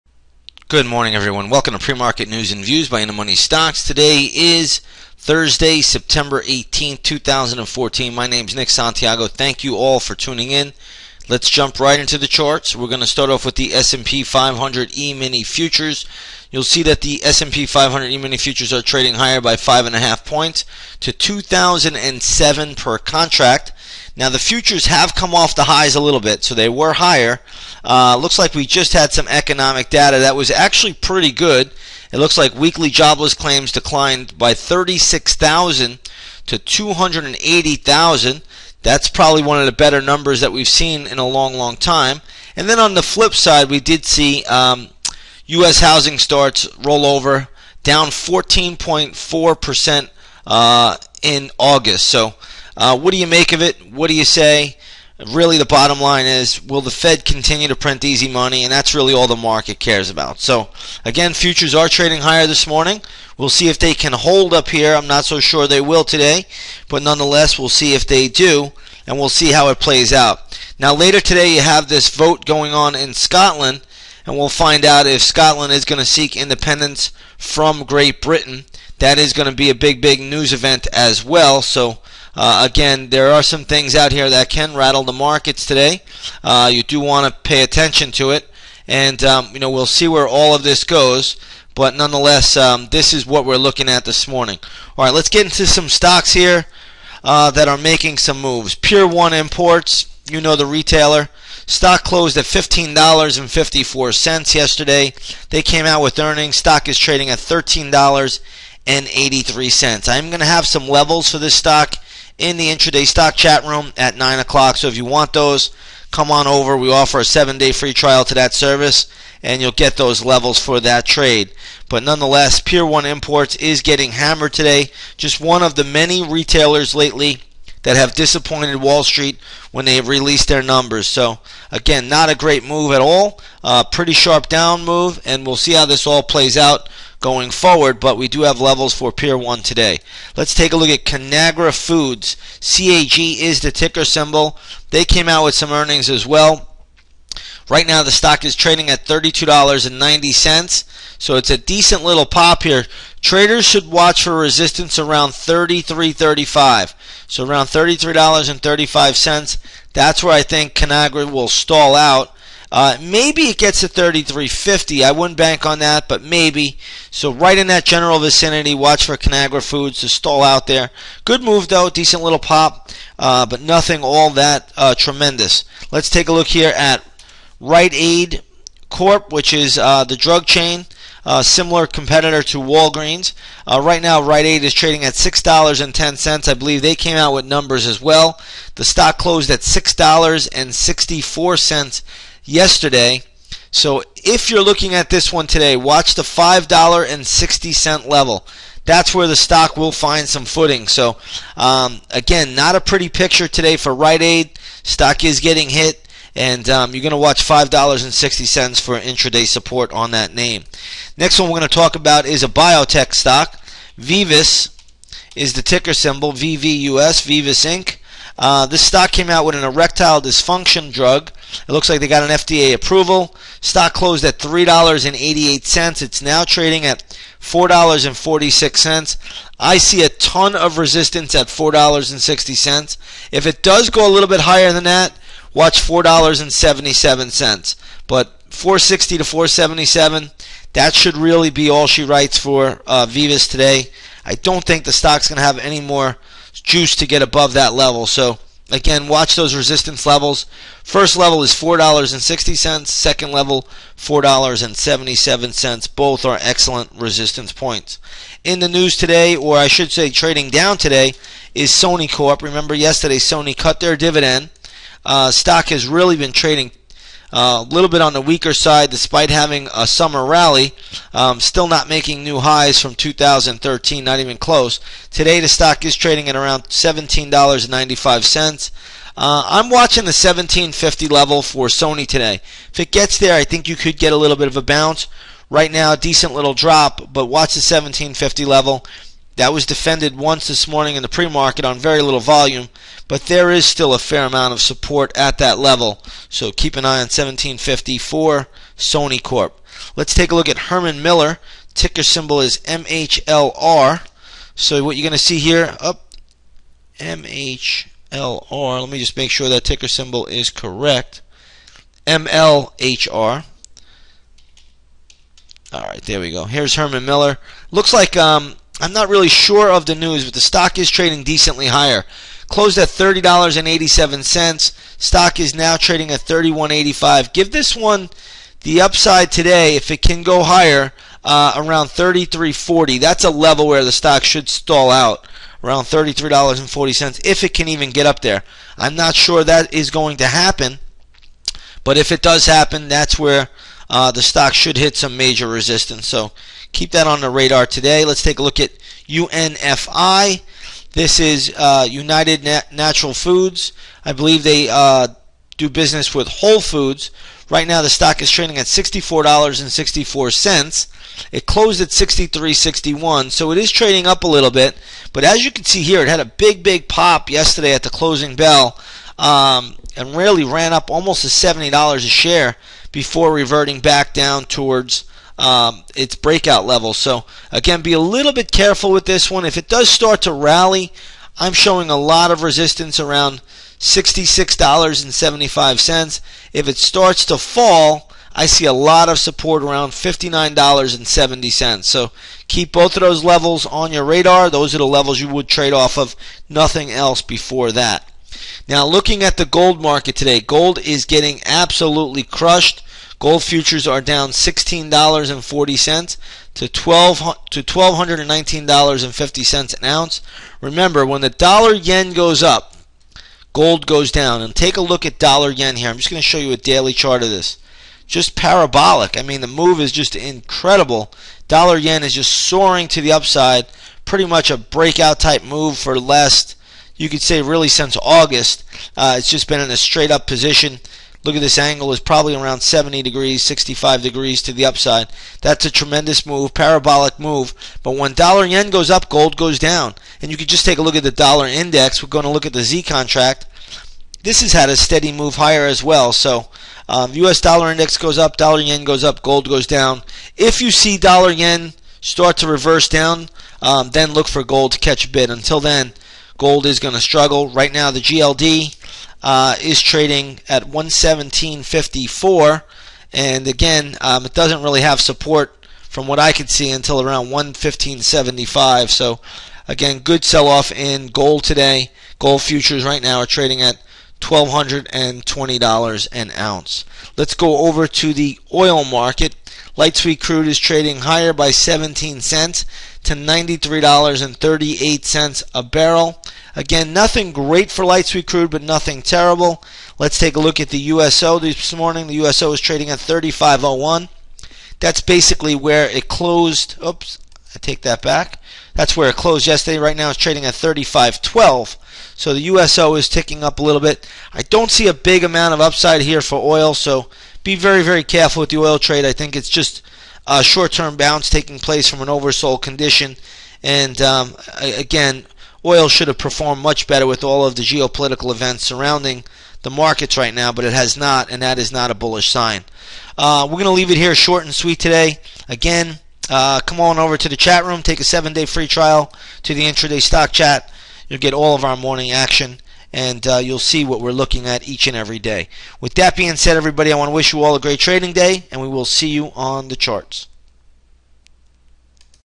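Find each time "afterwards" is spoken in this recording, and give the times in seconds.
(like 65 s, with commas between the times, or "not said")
not said.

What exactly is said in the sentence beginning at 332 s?
That's a level where the stock should stall out around $33.40 if it can even get up there.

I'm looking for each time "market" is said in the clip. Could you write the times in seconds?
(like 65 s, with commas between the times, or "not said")
1 s, 59 s, 85 s, 291 s, 399 s, 478 s, 519 s.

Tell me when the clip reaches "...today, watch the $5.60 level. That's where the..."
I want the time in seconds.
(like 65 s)
195 s.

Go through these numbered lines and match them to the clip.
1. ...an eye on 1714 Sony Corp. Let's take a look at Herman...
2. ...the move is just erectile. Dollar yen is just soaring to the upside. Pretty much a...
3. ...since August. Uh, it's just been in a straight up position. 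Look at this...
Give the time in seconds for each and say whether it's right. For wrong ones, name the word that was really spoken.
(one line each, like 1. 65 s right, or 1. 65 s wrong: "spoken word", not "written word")
1. 296 s wrong: "1754", not "1714"
2. 419 s wrong: "incredible", not "erectile"
3. 427 s right.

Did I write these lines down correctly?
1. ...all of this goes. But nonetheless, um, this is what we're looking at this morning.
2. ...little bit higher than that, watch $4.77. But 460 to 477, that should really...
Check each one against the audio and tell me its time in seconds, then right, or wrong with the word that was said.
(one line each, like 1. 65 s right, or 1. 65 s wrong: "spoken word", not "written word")
1. 90 s right
2. 234 s right.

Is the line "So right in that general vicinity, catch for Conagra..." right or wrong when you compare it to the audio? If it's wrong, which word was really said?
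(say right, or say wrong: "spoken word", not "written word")
wrong: "watch", not "catch".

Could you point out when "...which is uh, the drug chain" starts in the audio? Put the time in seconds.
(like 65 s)
179 s.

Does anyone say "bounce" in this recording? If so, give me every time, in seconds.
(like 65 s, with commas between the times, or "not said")
284 s, 510 s.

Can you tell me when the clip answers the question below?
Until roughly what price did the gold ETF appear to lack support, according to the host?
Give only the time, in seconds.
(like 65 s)
467 s.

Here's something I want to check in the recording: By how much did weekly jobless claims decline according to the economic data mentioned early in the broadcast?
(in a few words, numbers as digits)
36,000.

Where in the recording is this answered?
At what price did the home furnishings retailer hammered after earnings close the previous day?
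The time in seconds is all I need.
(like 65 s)
102 s.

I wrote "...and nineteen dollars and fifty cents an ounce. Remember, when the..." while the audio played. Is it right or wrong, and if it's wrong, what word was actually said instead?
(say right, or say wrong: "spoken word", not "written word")
right.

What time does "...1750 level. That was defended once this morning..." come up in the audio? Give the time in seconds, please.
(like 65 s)
287 s.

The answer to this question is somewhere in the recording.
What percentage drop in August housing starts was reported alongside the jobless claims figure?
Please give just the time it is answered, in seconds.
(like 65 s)
48 s.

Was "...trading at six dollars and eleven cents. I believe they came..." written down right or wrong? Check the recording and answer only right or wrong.
wrong.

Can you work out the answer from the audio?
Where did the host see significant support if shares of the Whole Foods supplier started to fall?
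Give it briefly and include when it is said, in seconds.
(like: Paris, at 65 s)
$59.70, at 389 s.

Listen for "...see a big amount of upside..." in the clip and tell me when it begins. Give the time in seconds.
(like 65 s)
504 s.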